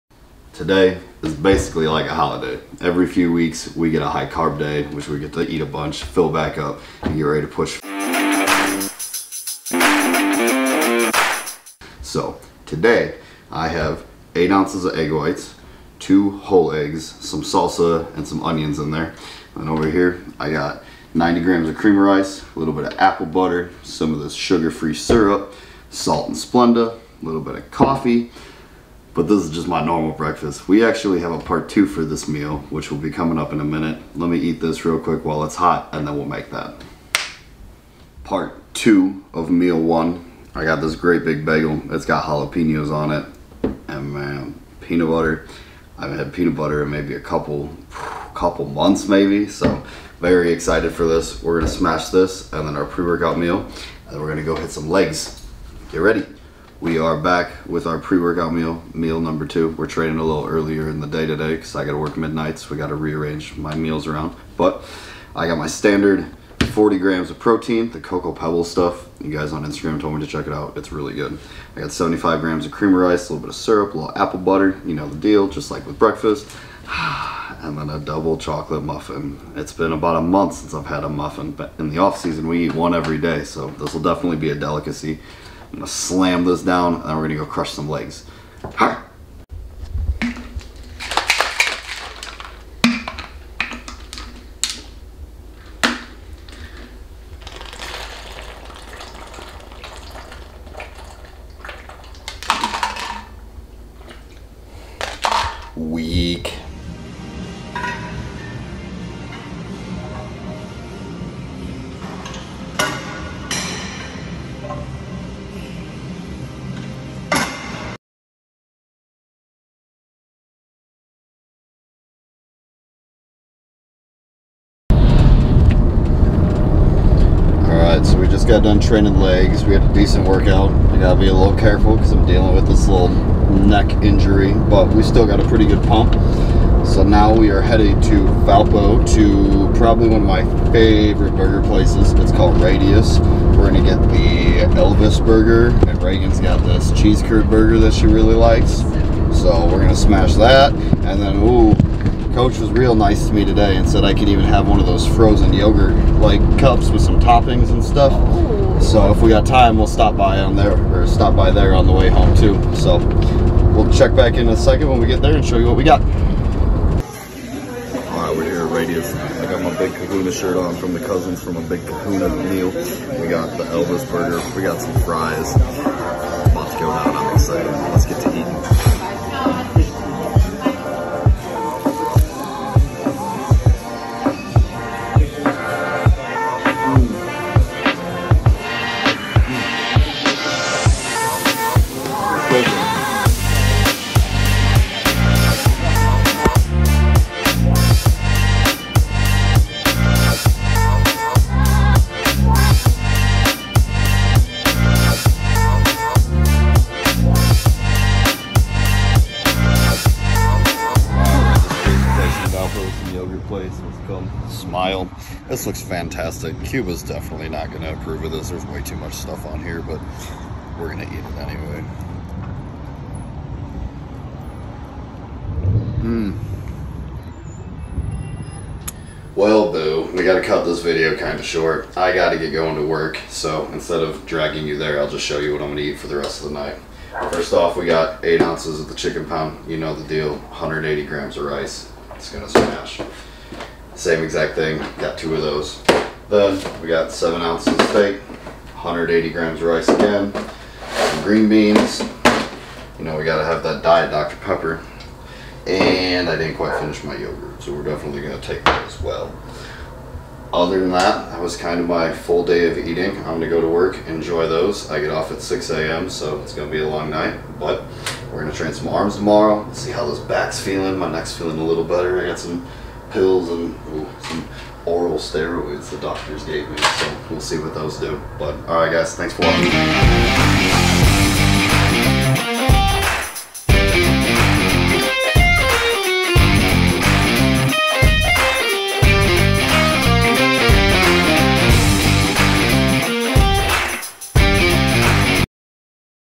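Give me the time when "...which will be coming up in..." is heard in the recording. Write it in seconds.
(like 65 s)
32 s.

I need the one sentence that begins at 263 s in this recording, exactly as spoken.
I'm gonna go to work, enjoy those.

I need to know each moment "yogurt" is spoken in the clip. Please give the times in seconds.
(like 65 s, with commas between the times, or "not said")
155 s, 257 s.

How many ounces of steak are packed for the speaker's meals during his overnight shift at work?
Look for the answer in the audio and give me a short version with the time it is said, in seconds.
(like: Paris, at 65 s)
7 ounces, at 247 s.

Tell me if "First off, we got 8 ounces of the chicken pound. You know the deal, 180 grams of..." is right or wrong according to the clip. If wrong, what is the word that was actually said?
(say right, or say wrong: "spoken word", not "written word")
right.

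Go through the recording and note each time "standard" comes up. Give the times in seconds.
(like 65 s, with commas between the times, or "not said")
65 s.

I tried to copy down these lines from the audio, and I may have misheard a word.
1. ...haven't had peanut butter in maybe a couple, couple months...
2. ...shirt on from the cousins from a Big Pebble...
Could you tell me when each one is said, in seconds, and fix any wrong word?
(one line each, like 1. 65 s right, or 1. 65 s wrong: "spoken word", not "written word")
1. 46 s right
2. 170 s wrong: "Kahuna", not "Pebble".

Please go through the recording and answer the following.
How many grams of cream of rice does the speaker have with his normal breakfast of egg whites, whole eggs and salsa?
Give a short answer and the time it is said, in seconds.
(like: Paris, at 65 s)
90 grams, at 21 s.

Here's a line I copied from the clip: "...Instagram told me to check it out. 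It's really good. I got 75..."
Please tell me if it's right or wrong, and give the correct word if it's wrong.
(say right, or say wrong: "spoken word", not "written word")
right.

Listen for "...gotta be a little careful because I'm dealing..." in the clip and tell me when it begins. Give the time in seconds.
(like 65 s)
130 s.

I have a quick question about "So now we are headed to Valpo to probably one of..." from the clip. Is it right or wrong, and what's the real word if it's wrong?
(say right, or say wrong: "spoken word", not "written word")
right.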